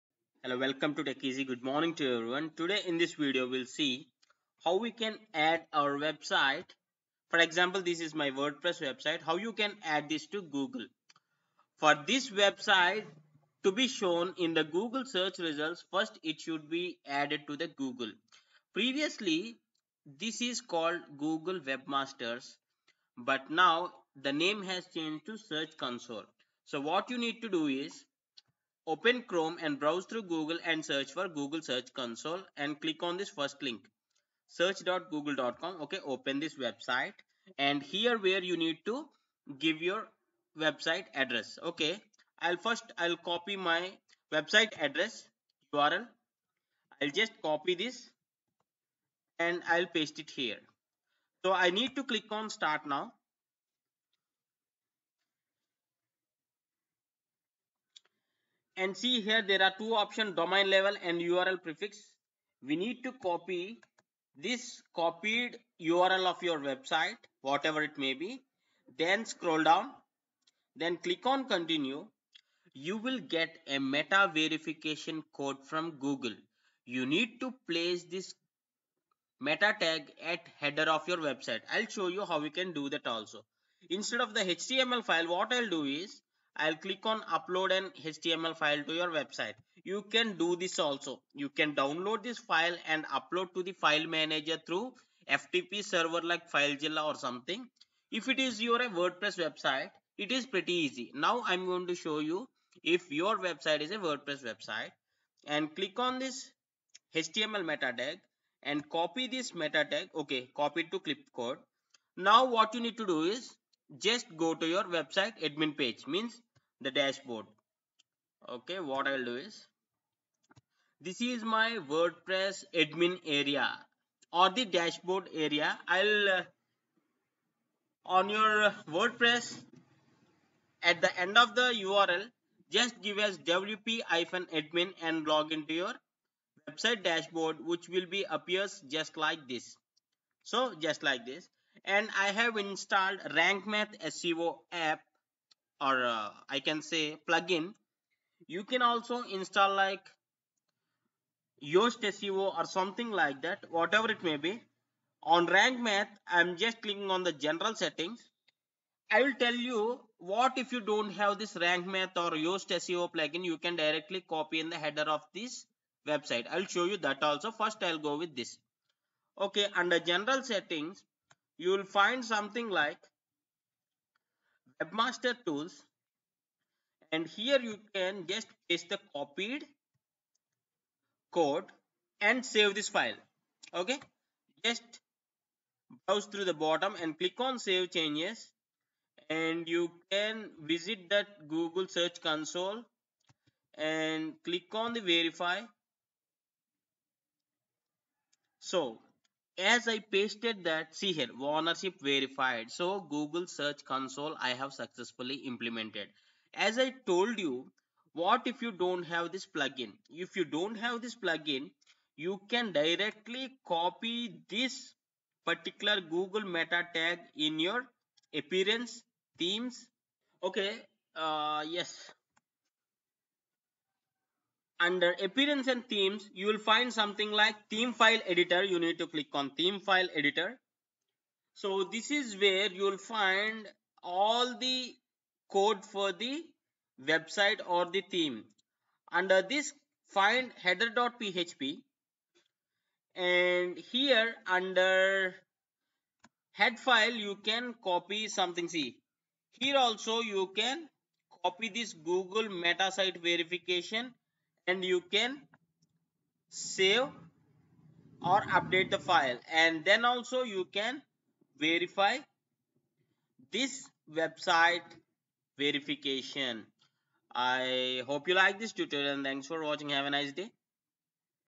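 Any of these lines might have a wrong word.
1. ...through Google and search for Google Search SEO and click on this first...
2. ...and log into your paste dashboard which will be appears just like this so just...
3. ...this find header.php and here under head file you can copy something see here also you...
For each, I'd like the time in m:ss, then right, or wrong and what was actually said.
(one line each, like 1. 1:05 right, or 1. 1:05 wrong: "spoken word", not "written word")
1. 0:30 wrong: "Console", not "SEO"
2. 2:15 wrong: "website", not "paste"
3. 3:59 right.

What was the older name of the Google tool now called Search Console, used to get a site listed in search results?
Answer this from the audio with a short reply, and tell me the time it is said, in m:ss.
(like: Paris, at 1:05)
Google Webmasters, at 0:21.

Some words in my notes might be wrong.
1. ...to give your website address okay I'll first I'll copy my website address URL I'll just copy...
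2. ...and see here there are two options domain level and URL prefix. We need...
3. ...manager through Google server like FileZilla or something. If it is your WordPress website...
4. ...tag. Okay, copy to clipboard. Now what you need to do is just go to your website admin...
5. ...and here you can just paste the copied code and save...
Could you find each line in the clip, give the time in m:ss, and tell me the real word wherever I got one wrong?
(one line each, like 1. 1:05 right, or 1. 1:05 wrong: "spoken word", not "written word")
1. 0:38 right
2. 0:58 right
3. 1:34 wrong: "FTP", not "Google"
4. 1:49 right
5. 2:57 right.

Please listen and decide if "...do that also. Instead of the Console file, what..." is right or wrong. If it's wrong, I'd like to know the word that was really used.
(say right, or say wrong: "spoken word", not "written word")
wrong: "HTML", not "Console".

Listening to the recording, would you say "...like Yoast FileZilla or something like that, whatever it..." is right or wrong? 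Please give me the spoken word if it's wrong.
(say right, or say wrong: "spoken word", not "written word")
wrong: "SEO", not "FileZilla".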